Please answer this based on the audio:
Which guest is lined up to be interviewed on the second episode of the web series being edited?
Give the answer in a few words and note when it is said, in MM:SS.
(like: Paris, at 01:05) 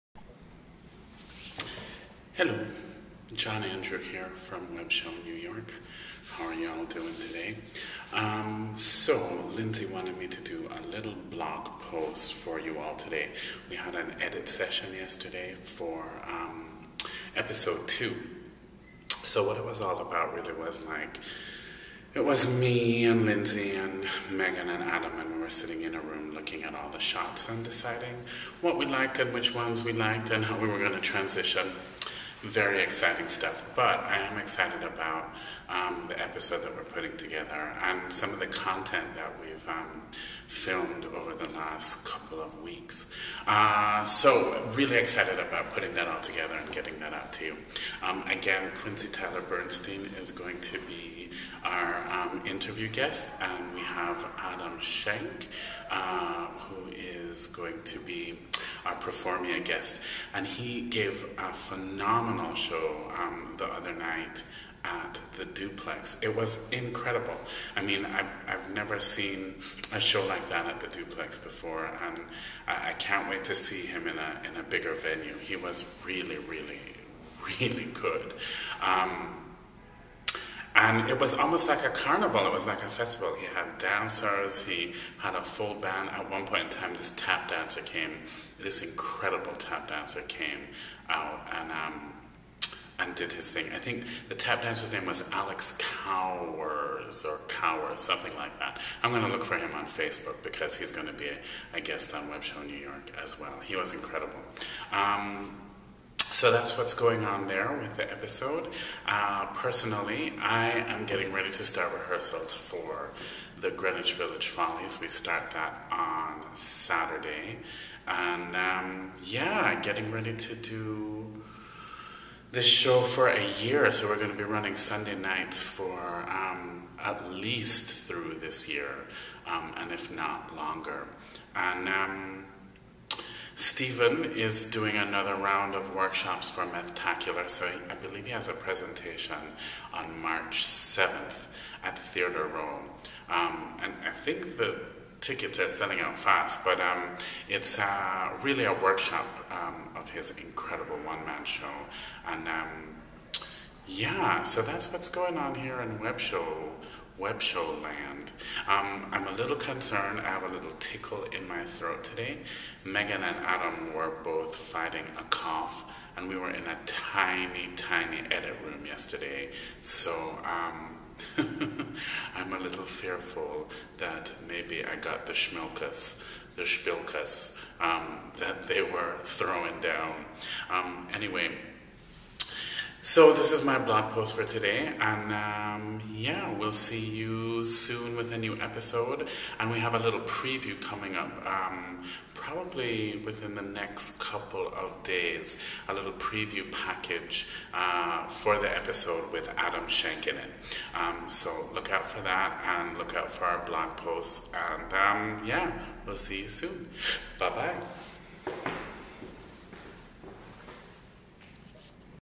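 Quincy Tyler Bernstein, at 00:48.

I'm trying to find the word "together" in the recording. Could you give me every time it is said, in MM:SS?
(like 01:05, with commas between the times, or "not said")
00:37, 00:46.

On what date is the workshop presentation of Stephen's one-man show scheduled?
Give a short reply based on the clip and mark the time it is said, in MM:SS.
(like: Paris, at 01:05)
March 7, at 02:20.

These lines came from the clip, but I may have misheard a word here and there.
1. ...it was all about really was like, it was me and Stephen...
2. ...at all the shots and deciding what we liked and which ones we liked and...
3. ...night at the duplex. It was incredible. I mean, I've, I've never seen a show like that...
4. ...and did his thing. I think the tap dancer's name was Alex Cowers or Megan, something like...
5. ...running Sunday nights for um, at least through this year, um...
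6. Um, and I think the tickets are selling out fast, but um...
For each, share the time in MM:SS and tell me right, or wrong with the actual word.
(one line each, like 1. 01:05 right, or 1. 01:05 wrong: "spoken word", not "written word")
1. 00:19 wrong: "Lindsay", not "Stephen"
2. 00:26 right
3. 01:03 right
4. 01:32 wrong: "Cowers", not "Megan"
5. 02:04 right
6. 02:23 right.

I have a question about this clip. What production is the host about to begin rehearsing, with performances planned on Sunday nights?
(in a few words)
Greenwich Village Follies.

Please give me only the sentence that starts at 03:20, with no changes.
Um, so look out for that, and look out for our blog posts, and um, yeah, we'll see you soon.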